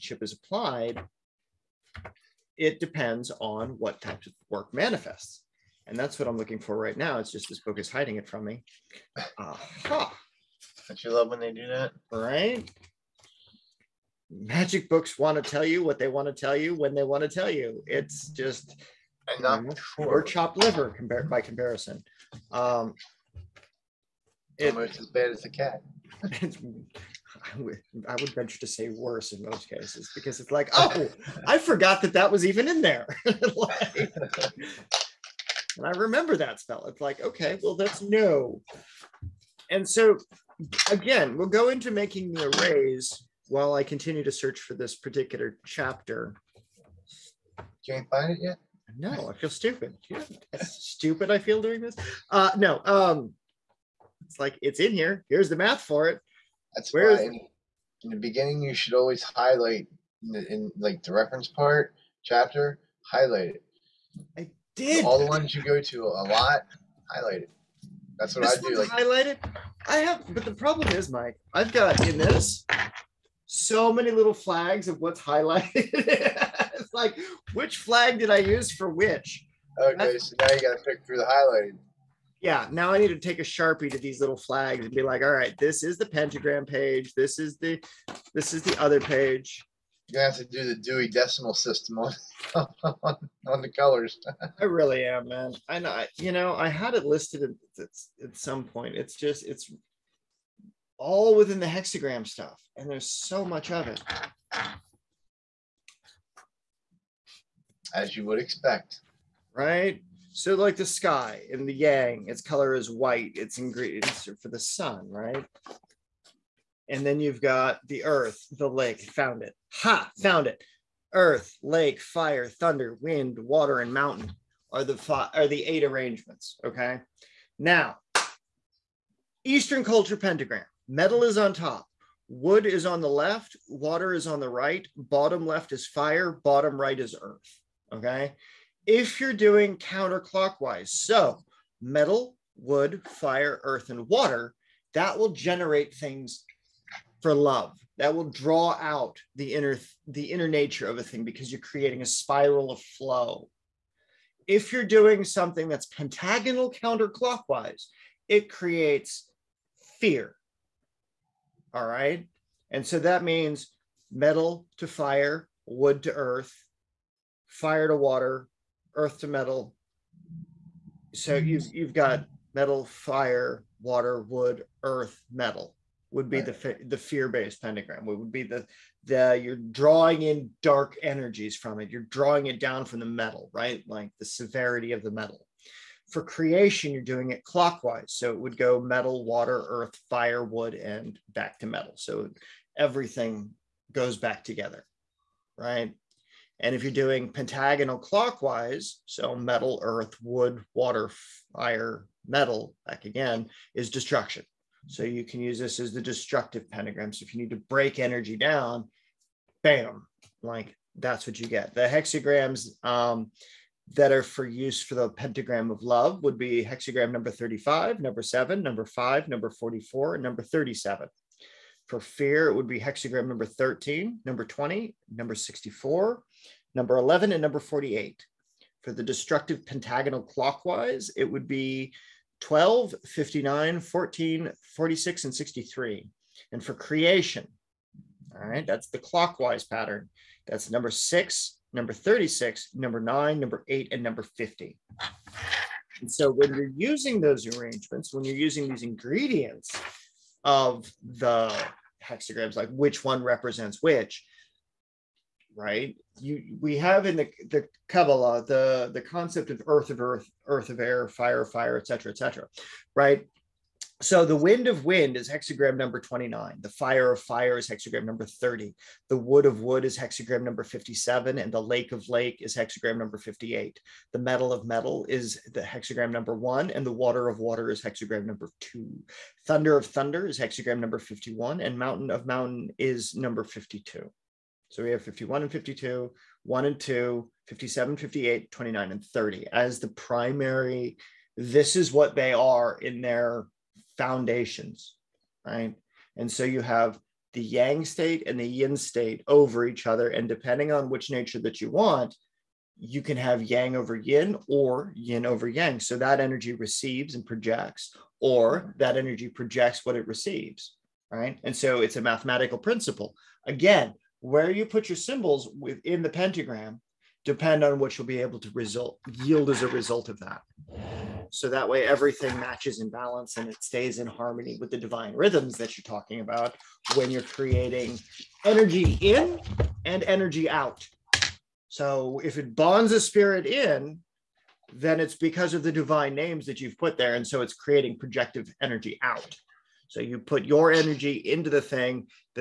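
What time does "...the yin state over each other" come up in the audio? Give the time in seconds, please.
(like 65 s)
298 s.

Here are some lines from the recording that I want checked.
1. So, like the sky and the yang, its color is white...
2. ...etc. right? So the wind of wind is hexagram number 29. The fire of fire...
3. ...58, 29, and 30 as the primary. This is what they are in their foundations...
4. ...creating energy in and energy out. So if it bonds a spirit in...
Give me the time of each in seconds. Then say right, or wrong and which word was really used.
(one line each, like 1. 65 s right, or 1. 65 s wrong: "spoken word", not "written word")
1. 110 s right
2. 262 s right
3. 287 s right
4. 327 s right.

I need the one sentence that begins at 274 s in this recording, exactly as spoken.
The metal of metal is the hexagram number one.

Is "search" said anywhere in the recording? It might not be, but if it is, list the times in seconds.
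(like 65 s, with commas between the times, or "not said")
44 s.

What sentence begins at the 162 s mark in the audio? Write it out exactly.
And so that means metal to fire, wood to earth, fire to water, earth to metal.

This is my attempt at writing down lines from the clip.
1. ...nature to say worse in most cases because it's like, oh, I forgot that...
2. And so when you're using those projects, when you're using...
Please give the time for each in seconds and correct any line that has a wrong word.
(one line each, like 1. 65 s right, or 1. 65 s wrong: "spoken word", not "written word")
1. 28 s wrong: "venture", not "nature"
2. 246 s wrong: "arrangements", not "projects".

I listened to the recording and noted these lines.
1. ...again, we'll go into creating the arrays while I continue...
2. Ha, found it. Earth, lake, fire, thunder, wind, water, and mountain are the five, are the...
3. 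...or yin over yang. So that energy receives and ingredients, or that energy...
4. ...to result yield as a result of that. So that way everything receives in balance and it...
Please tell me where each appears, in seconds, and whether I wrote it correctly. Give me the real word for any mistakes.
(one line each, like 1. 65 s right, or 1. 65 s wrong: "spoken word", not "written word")
1. 40 s wrong: "making", not "creating"
2. 119 s right
3. 304 s wrong: "projects", not "ingredients"
4. 318 s wrong: "matches", not "receives".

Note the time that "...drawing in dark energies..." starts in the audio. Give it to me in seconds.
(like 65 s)
179 s.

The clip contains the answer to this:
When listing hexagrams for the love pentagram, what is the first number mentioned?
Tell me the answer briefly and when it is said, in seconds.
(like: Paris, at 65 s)
35, at 216 s.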